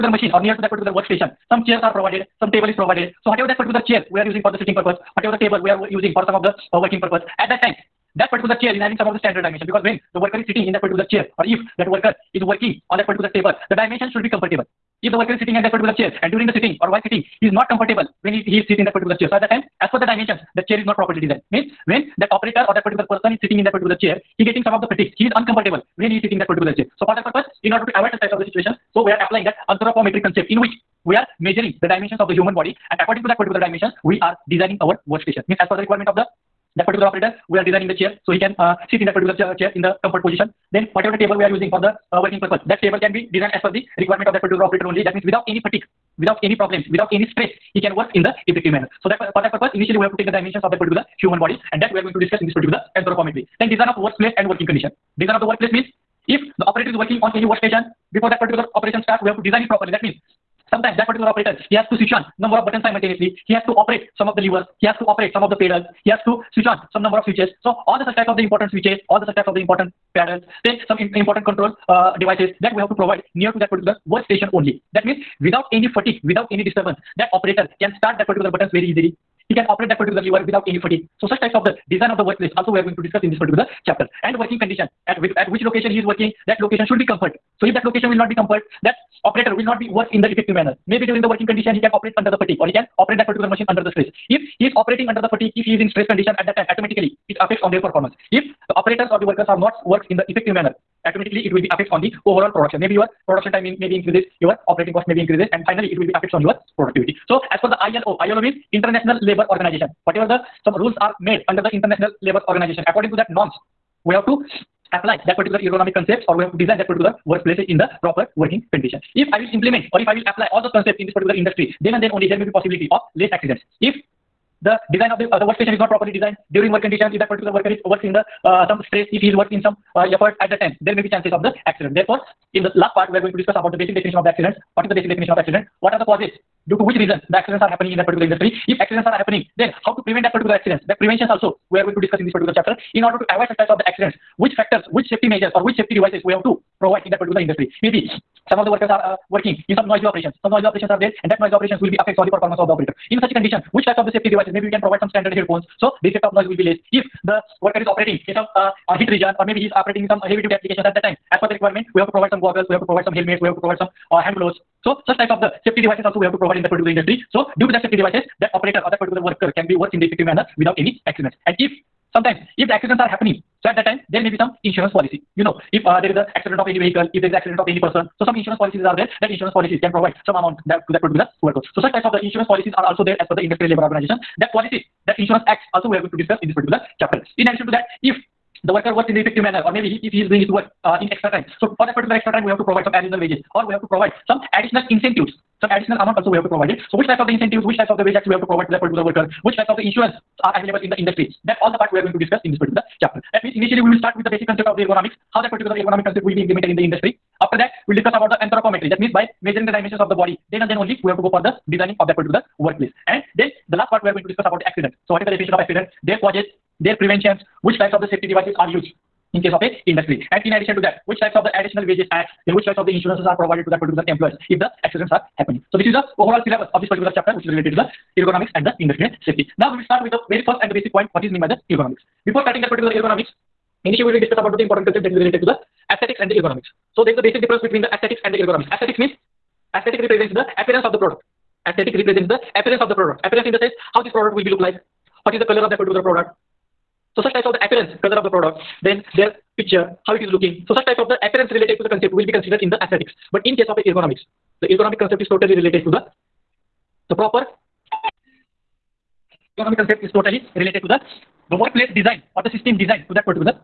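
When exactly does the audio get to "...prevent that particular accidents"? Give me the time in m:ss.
2:20.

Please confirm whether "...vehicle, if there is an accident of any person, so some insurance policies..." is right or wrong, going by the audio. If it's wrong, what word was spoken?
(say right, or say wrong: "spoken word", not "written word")
right.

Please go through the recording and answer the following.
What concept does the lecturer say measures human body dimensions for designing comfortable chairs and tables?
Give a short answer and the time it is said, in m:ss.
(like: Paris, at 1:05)
anthropometric, at 0:29.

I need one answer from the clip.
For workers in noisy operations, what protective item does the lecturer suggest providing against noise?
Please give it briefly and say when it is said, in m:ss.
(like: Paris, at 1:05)
standard headphones, at 2:35.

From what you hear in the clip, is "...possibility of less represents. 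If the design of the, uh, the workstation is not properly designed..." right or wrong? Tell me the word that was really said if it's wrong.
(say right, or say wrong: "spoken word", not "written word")
wrong: "accidents", not "represents".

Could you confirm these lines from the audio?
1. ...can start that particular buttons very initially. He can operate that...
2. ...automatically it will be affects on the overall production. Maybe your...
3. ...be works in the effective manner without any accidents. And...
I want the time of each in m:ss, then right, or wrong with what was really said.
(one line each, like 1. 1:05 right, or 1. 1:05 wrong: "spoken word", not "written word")
1. 1:17 wrong: "easily", not "initially"
2. 1:41 right
3. 2:49 right.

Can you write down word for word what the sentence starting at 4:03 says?
Appearance in the sense how this product will be look like, what is the color of that particular product.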